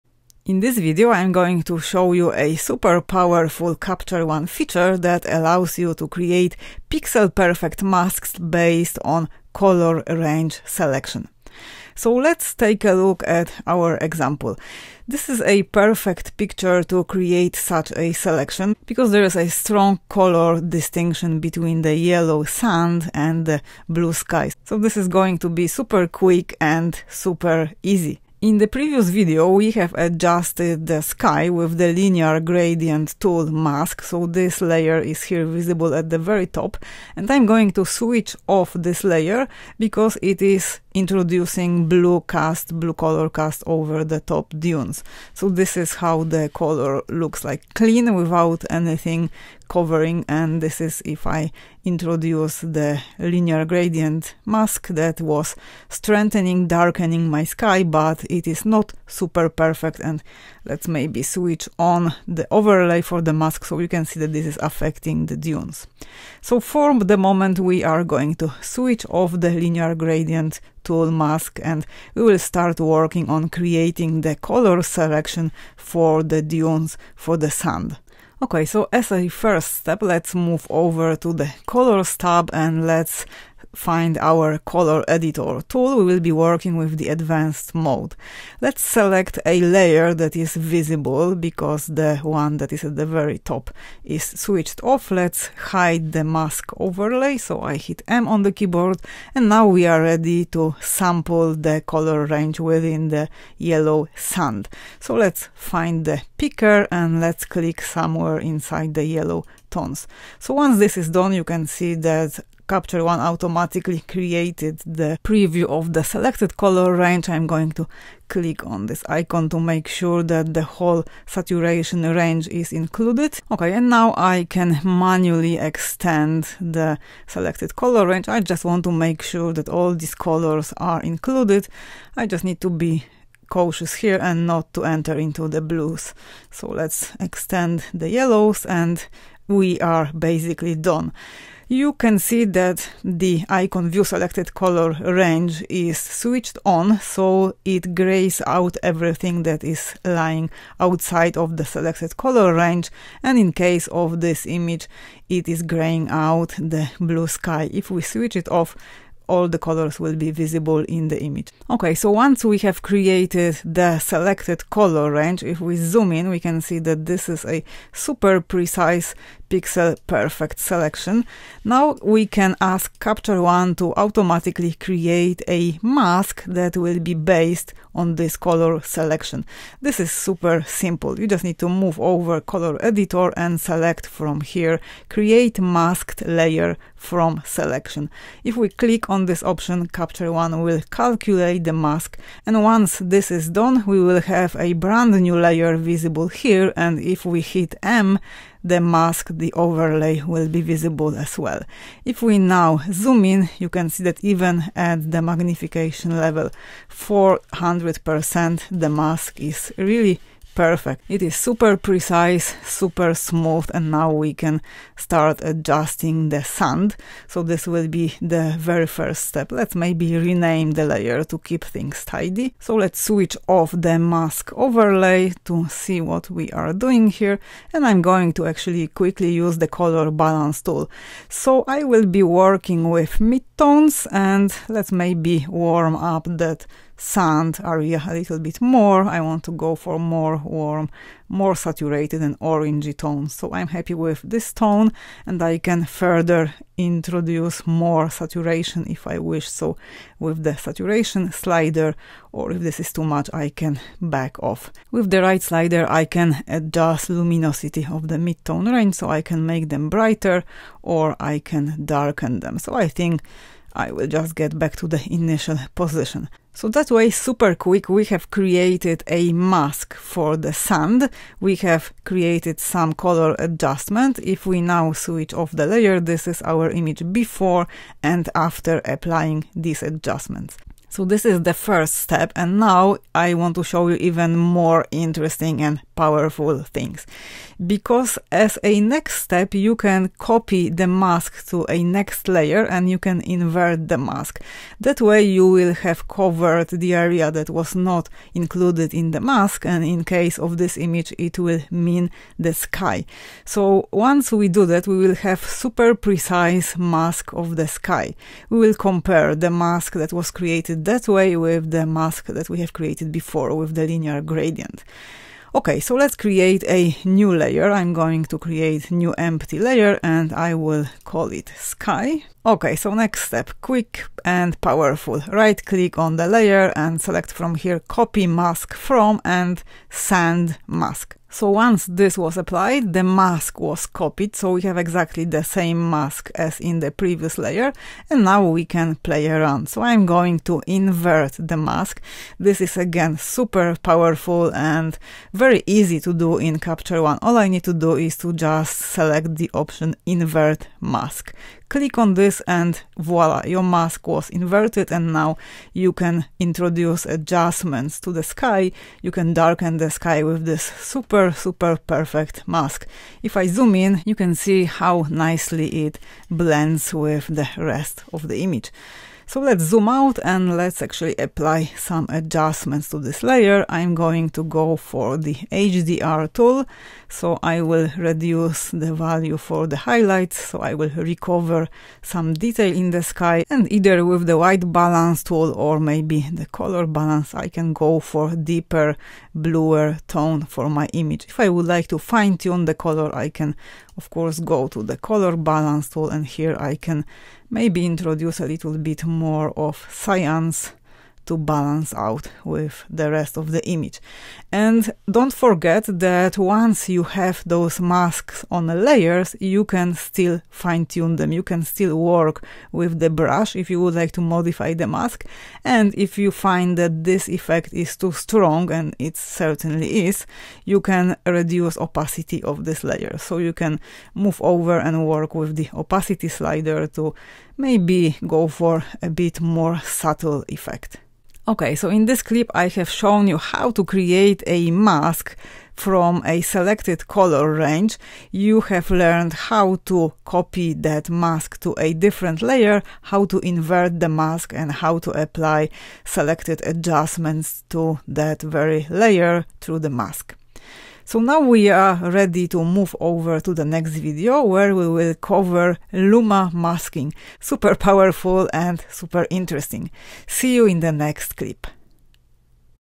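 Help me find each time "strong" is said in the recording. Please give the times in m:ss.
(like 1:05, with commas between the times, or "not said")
0:19, 6:58.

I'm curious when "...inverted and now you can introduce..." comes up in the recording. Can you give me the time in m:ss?
5:54.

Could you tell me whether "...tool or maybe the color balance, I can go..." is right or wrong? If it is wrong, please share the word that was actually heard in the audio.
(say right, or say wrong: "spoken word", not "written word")
right.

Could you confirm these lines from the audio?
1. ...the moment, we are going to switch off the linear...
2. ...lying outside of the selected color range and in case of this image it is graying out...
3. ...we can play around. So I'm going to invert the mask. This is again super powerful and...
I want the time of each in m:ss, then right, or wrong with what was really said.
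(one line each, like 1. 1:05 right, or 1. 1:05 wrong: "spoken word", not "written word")
1. 1:06 right
2. 2:30 right
3. 5:38 right.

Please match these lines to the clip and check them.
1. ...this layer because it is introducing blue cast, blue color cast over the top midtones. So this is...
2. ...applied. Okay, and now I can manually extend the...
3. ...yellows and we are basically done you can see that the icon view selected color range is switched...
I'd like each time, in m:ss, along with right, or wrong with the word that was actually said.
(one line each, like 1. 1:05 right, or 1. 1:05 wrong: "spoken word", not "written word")
1. 0:38 wrong: "dunes", not "midtones"
2. 2:02 wrong: "included", not "applied"
3. 2:18 right.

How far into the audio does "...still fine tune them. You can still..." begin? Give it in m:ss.
6:49.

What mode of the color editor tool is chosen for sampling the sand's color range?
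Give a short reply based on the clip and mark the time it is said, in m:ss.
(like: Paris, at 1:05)
Advanced mode, at 1:27.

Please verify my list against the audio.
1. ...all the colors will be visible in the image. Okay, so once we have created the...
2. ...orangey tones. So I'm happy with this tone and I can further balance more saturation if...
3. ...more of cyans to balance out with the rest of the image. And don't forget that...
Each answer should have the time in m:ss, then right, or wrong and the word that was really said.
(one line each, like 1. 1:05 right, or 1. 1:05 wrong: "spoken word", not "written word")
1. 2:39 right
2. 4:02 wrong: "introduce", not "balance"
3. 6:39 right.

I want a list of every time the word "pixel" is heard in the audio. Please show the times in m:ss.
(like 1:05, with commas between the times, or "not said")
0:06, 2:49.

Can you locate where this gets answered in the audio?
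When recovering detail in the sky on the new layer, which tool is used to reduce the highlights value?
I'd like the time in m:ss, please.
6:15.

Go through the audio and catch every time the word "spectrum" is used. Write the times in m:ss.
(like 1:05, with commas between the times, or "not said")
not said.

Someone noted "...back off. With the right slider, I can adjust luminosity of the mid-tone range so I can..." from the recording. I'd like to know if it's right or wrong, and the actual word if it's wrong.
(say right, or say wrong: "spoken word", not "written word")
right.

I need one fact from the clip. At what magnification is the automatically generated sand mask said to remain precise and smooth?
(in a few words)
400%.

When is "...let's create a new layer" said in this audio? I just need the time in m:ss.
5:15.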